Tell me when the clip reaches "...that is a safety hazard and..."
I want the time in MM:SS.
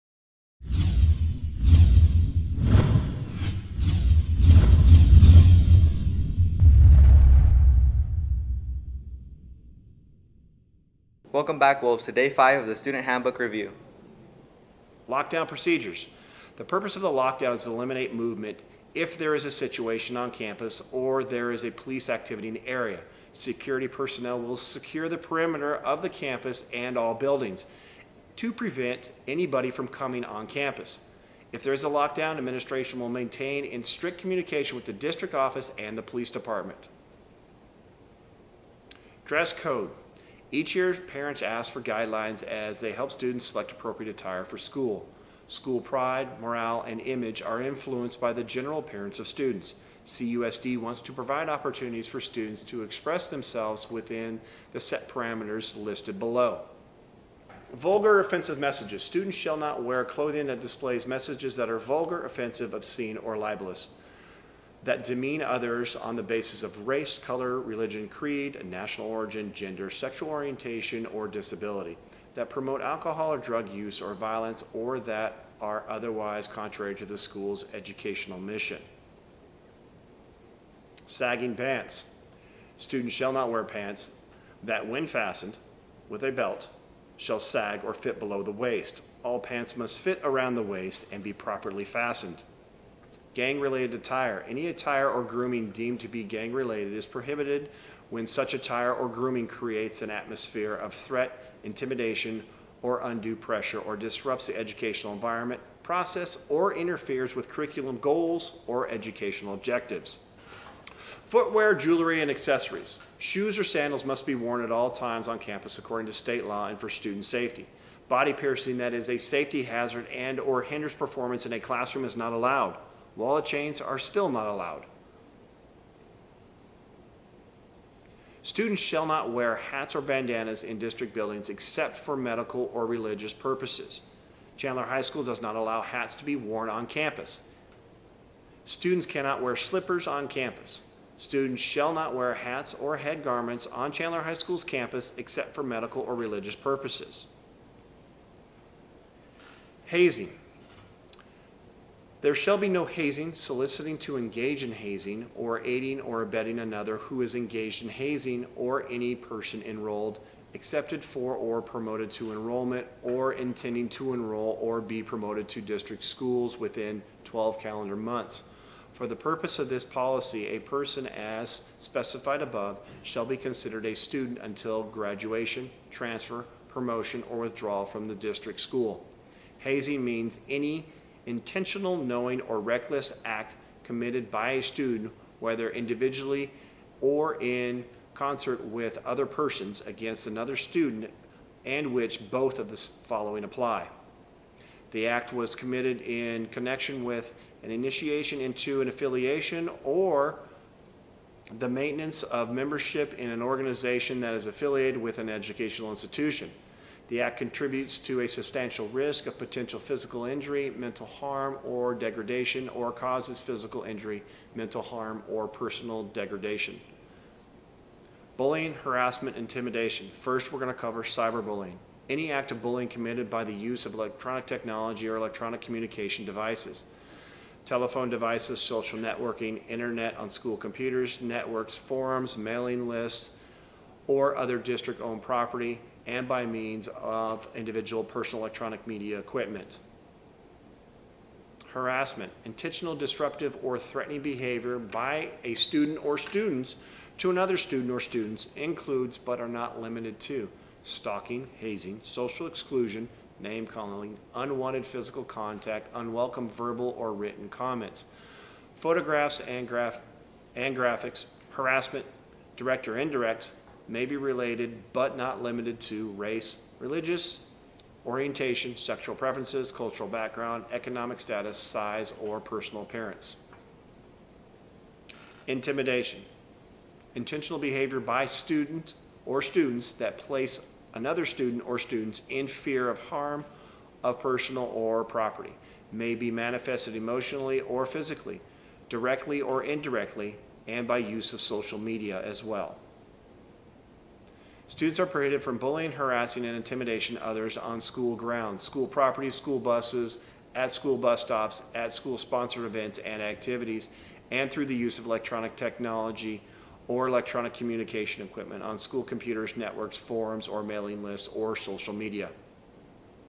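01:58.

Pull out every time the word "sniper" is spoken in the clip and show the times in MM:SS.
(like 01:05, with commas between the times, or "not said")
not said.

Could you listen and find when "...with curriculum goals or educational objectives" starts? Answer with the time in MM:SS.
01:47.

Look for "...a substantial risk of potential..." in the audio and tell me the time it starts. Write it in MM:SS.
03:28.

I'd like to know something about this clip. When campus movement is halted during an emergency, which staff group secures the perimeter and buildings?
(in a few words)
Security personnel.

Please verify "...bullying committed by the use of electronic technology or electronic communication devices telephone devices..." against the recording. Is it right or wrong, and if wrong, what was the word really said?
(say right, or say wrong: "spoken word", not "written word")
right.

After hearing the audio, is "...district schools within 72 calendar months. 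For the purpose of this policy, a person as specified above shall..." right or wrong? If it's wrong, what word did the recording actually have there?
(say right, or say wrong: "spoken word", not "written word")
wrong: "12", not "72".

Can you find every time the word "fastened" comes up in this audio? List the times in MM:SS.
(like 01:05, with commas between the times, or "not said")
01:25, 01:31.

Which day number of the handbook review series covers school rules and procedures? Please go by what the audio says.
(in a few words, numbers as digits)
day 5.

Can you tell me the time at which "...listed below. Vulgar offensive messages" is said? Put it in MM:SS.
00:55.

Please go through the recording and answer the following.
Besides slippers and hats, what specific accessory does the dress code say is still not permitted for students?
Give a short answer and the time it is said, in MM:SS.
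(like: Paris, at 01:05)
Wallet chains, at 02:03.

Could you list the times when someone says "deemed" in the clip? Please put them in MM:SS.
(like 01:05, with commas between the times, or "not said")
01:35.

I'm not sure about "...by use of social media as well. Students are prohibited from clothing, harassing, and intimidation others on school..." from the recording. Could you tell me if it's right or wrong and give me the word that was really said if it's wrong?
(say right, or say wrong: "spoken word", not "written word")
wrong: "bullying", not "clothing".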